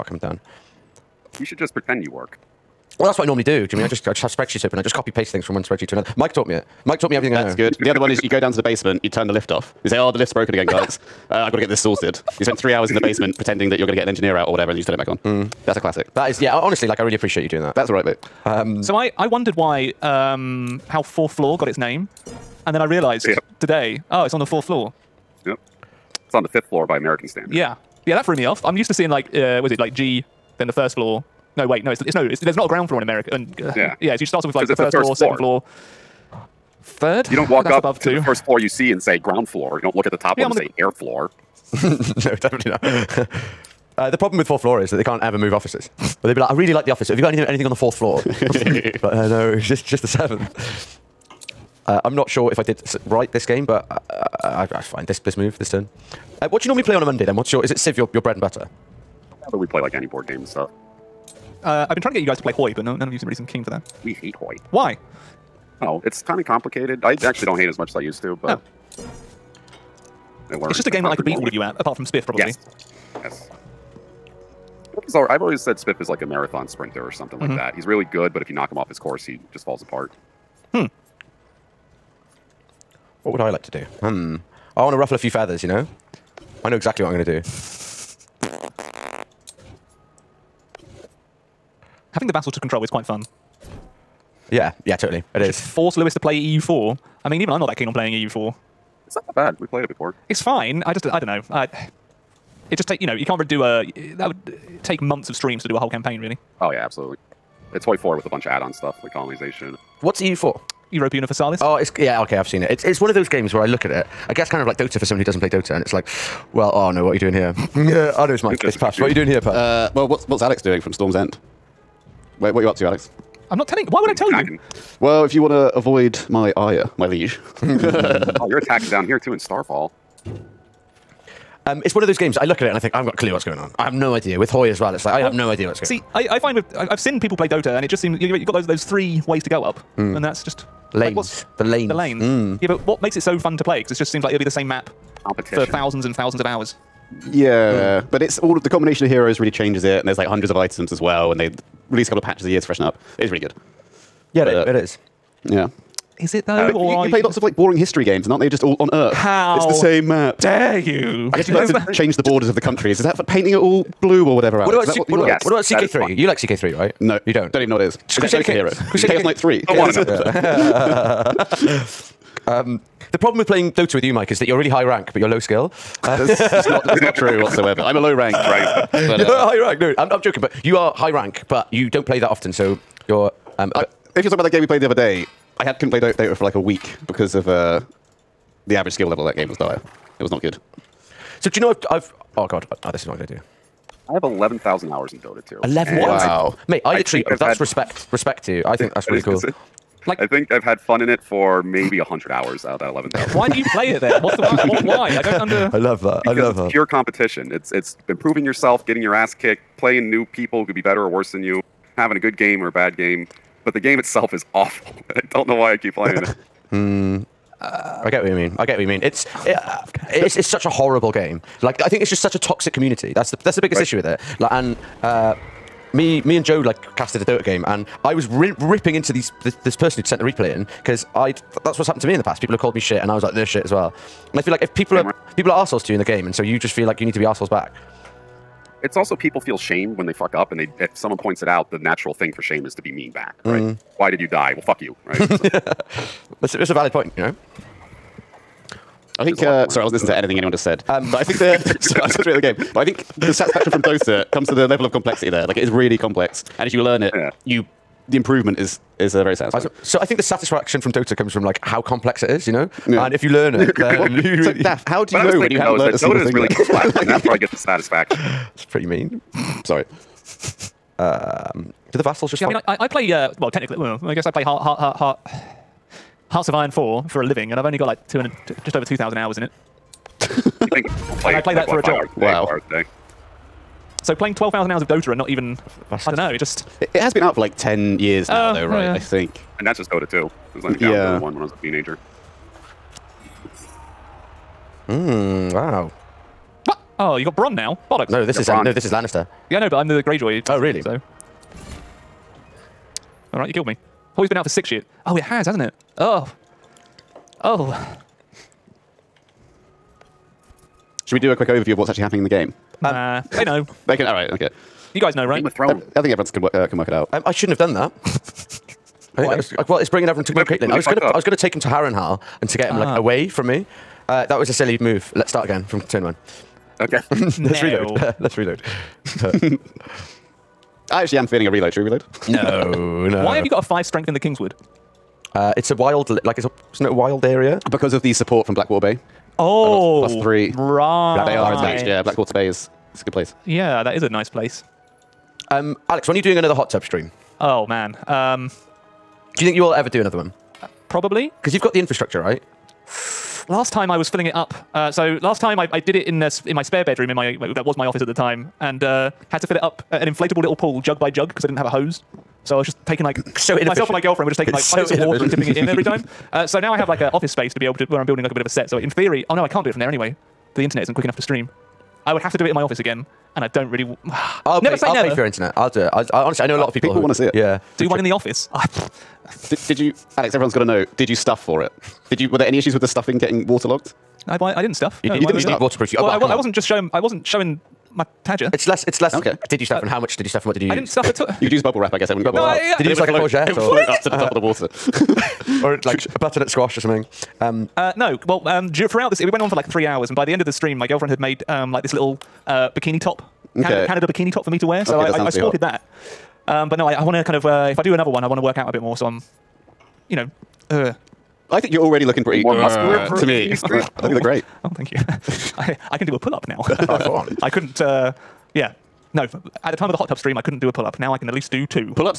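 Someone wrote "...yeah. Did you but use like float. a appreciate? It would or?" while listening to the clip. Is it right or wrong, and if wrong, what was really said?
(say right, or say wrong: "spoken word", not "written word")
wrong: "courgette", not "appreciate".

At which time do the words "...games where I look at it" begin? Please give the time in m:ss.
1:53.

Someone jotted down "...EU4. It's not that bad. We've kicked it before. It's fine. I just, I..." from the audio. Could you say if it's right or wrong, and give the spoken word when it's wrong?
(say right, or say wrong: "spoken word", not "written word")
wrong: "played", not "kicked".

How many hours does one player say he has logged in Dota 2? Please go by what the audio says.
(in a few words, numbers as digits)
11,000.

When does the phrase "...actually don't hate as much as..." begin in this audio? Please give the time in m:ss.
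1:07.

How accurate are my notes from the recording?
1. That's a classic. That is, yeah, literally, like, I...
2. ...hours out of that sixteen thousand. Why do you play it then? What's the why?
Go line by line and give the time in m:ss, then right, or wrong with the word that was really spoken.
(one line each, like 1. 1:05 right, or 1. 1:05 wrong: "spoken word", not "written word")
1. 0:15 wrong: "honestly", not "literally"
2. 3:22 wrong: "eleven", not "sixteen".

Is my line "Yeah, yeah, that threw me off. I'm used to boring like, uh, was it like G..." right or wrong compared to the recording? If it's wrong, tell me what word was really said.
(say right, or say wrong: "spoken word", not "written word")
wrong: "seeing", not "boring".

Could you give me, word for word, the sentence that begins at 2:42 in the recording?
Is that for painting it all blue or whatever?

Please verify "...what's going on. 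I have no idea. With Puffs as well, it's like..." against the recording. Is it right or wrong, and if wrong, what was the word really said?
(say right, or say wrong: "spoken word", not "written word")
wrong: "Hoy", not "Puffs".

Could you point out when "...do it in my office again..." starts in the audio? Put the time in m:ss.
6:12.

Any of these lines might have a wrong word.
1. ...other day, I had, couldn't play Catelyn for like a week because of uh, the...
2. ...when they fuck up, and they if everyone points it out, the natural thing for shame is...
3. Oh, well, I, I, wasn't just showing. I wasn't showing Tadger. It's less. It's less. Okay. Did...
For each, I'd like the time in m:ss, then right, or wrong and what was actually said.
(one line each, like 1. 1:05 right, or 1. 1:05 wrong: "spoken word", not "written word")
1. 3:04 wrong: "Dota", not "Catelyn"
2. 3:59 wrong: "someone", not "everyone"
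3. 6:25 right.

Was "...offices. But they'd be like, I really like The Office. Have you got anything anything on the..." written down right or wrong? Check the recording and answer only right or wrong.
right.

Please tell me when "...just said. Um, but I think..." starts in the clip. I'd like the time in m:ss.
4:10.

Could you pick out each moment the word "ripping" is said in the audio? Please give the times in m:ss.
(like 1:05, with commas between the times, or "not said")
3:48.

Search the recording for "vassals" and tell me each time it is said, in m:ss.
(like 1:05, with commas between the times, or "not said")
4:32.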